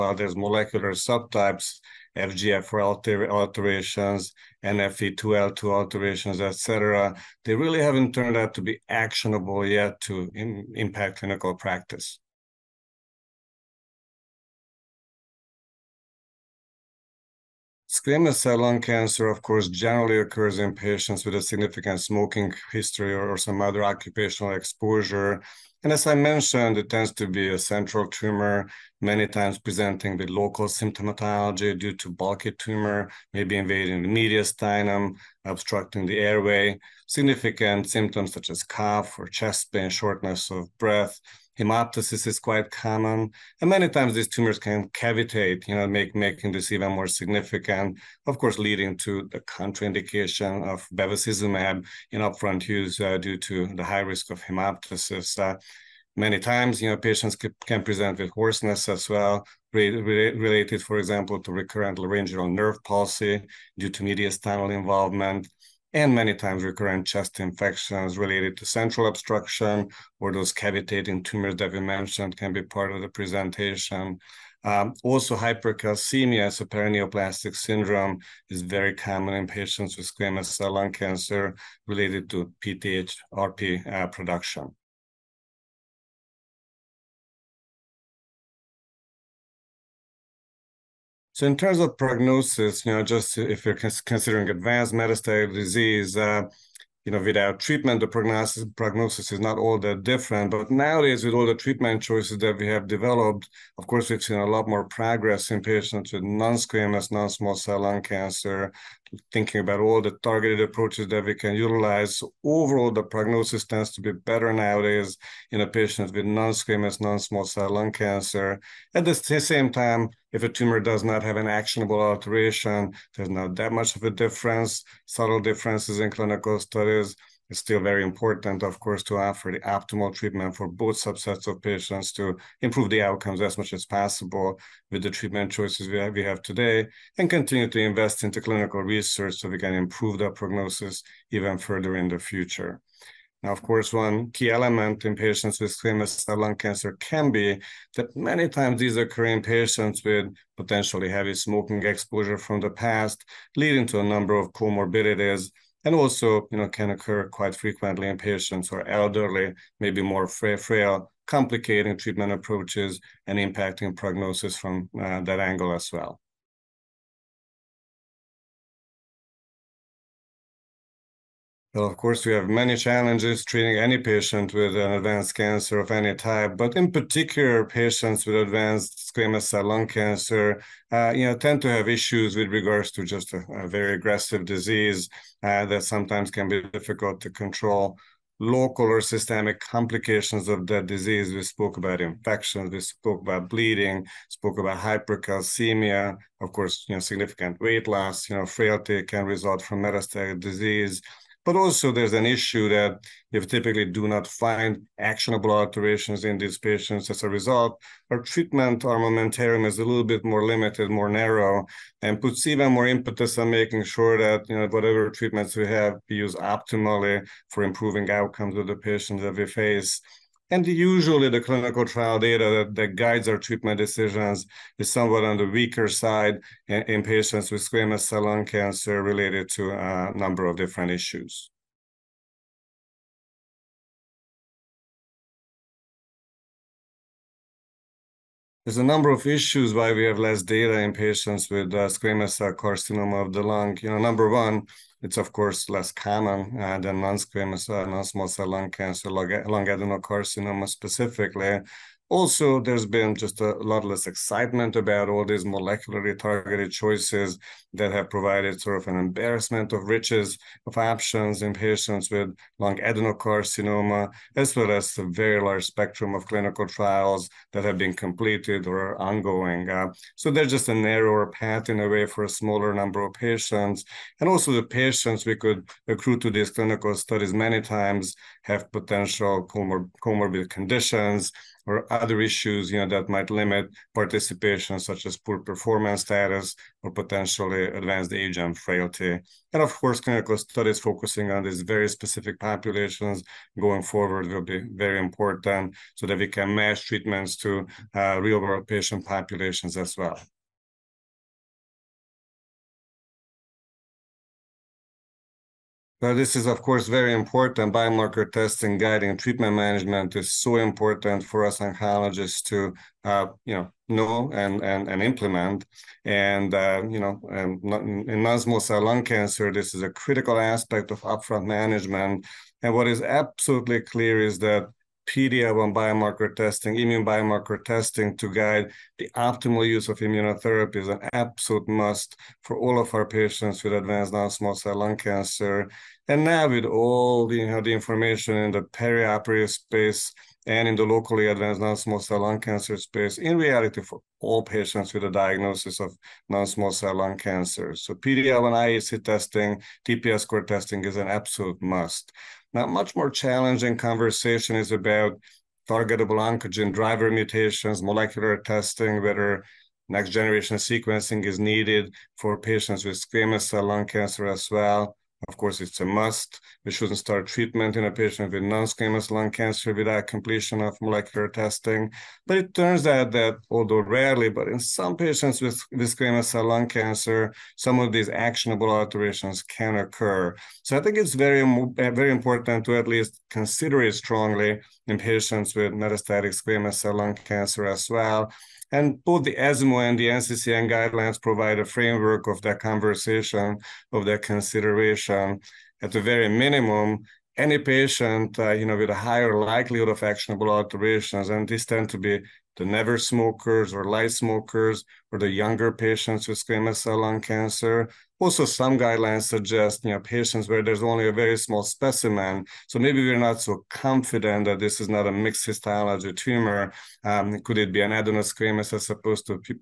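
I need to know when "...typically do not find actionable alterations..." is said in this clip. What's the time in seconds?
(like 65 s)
203 s.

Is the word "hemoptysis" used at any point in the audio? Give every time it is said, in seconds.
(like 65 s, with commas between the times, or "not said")
41 s, 54 s.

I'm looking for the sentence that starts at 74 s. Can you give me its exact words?
Um, also, hypercalcemia, so paraneoplastic syndrome, is very common in patients with squamous cell lung cancer related to PTH-RP uh, production.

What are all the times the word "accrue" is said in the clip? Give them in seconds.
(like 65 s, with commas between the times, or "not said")
275 s.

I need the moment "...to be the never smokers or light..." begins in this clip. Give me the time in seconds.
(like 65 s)
401 s.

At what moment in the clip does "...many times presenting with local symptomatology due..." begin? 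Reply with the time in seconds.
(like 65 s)
29 s.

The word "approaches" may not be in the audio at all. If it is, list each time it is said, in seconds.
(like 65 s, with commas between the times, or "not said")
110 s, 162 s.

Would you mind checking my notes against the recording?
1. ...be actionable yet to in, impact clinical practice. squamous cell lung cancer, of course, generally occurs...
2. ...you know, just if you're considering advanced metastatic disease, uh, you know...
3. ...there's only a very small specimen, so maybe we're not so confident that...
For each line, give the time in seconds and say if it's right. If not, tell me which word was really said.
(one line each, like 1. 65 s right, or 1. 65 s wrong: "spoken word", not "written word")
1. 8 s right
2. 92 s right
3. 410 s right.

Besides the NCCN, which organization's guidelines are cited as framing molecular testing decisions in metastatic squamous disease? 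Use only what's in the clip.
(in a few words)
ESMO.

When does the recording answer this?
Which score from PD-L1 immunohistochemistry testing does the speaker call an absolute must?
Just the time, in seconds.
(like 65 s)
349 s.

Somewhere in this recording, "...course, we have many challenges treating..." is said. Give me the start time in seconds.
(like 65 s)
171 s.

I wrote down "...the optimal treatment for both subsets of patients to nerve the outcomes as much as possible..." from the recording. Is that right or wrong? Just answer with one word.
wrong.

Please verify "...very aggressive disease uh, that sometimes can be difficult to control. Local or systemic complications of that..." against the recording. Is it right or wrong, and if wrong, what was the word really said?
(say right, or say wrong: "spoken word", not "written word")
right.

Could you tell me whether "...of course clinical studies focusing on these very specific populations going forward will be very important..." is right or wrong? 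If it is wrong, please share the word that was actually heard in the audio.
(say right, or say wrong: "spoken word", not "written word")
right.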